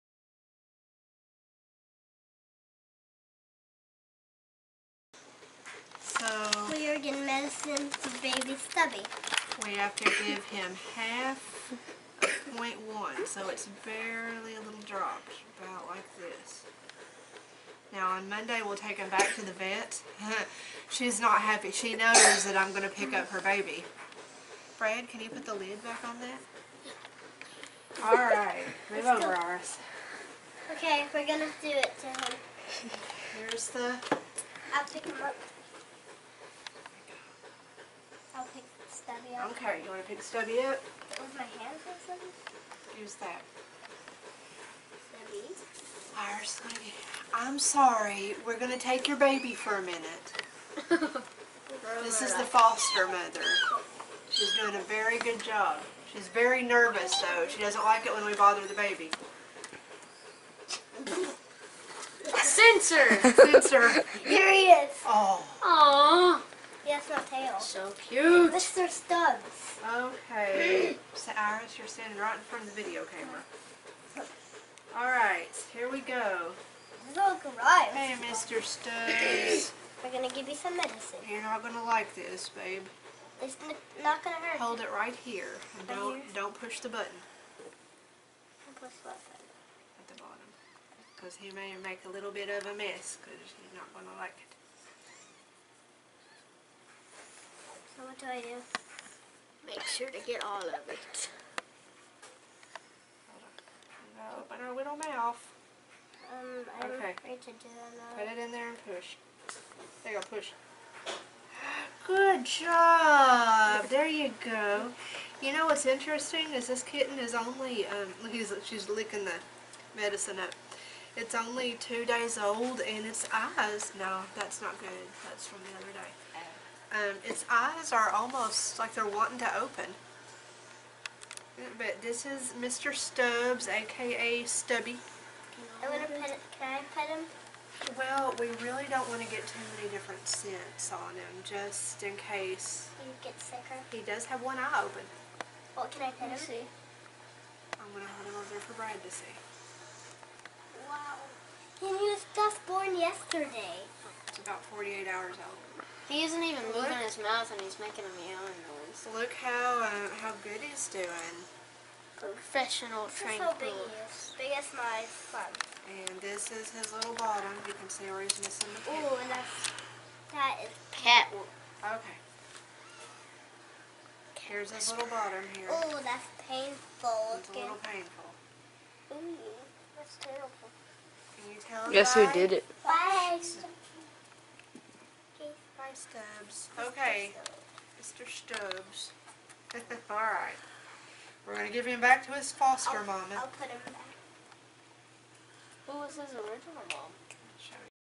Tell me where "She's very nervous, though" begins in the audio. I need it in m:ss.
0:56.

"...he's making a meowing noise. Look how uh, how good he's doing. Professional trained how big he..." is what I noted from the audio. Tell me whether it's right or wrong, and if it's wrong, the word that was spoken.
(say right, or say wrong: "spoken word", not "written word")
right.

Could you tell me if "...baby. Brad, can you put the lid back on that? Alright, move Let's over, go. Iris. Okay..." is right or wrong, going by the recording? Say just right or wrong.
right.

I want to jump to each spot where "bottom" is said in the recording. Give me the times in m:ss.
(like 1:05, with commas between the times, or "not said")
1:30, 2:47, 2:55.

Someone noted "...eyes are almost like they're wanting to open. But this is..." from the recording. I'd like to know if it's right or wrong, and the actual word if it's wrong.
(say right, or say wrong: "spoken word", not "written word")
right.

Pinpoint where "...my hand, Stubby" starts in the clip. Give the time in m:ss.
0:41.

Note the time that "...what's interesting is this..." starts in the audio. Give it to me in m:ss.
1:55.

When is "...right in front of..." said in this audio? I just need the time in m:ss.
1:12.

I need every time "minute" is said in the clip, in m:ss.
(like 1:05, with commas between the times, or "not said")
0:49.